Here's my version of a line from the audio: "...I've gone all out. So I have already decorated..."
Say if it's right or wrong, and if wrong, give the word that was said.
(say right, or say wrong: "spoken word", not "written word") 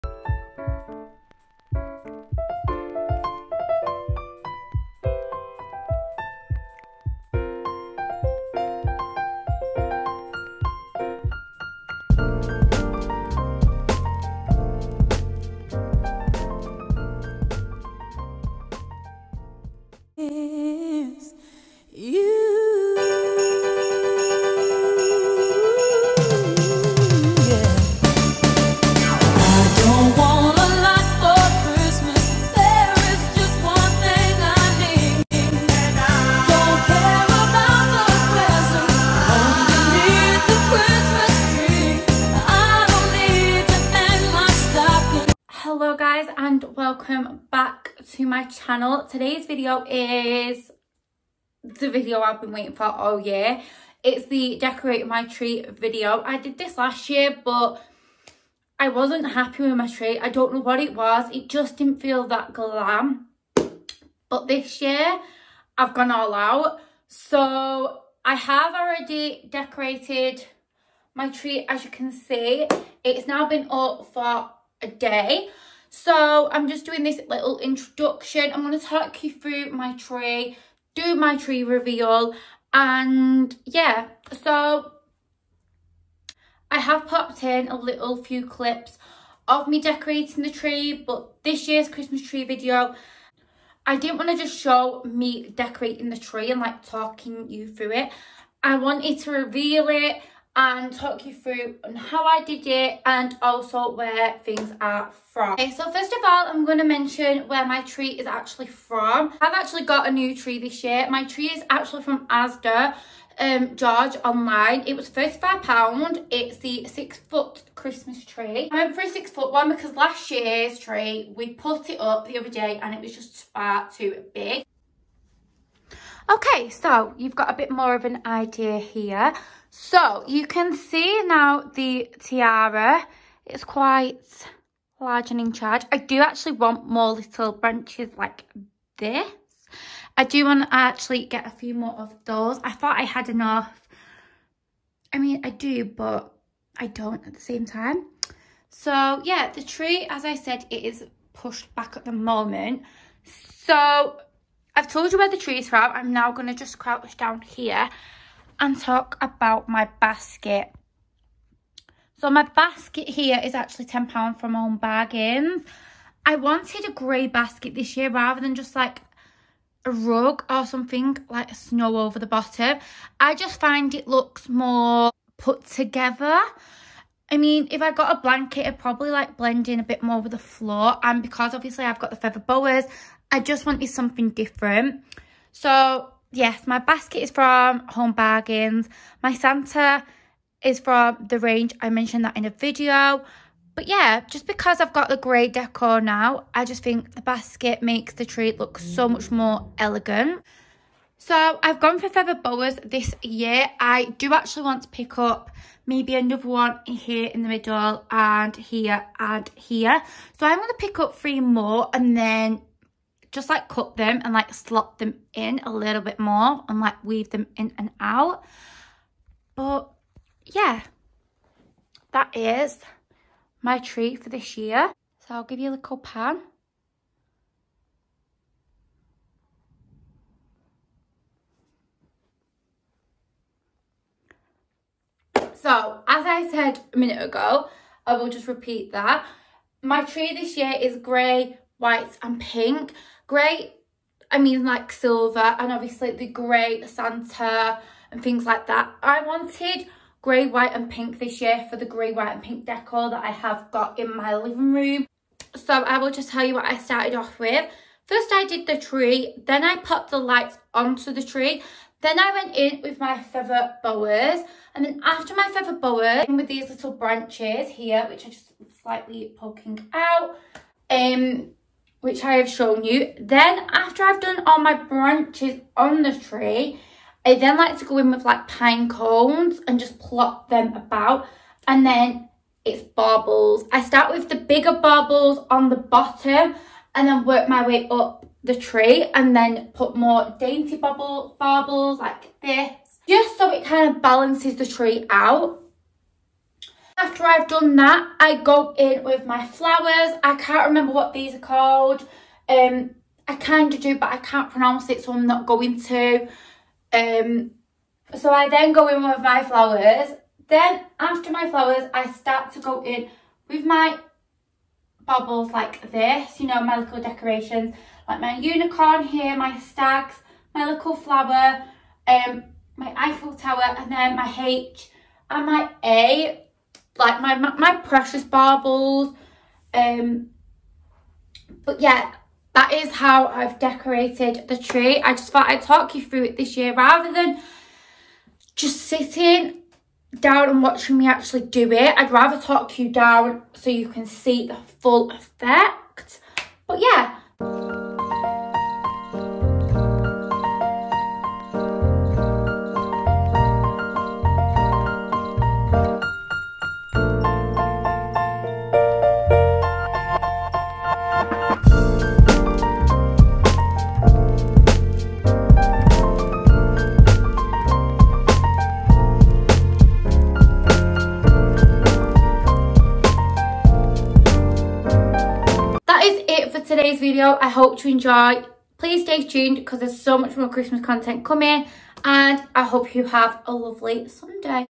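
right.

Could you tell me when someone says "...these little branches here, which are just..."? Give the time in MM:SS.
04:26.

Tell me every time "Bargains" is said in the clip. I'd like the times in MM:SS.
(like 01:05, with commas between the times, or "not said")
02:44, 03:08.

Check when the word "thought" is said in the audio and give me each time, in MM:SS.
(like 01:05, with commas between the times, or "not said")
02:22, 05:35.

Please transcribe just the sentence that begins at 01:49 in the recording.
I've actually got a new tree this year.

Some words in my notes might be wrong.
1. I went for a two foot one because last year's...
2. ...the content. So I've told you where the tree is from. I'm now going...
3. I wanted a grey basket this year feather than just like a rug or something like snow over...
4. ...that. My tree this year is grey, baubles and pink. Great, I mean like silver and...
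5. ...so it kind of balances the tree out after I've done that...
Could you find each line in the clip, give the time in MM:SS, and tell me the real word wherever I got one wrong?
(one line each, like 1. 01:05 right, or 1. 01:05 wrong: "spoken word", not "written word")
1. 01:58 wrong: "six", not "two"
2. 02:32 wrong: "moment", not "content"
3. 02:46 wrong: "rather", not "feather"
4. 03:58 wrong: "whites", not "baubles"
5. 04:53 right.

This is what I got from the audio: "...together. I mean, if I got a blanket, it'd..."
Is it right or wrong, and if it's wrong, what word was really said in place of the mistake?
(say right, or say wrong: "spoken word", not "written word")
right.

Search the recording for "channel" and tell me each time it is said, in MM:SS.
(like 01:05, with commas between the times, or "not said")
00:48.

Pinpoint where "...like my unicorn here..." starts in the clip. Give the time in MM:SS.
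05:18.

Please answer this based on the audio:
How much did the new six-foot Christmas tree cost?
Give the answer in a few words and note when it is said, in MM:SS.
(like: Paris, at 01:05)
£35, at 01:55.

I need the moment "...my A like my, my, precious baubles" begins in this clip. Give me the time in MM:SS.
05:25.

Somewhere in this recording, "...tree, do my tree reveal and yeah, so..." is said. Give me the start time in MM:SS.
01:19.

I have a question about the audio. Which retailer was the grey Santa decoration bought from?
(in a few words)
The Range.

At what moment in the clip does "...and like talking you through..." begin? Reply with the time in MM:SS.
01:36.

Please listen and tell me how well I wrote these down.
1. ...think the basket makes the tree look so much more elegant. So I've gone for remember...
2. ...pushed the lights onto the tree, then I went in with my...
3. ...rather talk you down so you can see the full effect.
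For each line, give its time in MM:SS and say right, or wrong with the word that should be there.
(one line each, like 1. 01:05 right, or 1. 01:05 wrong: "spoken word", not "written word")
1. 03:16 wrong: "feather", not "remember"
2. 04:19 wrong: "popped", not "pushed"
3. 05:42 right.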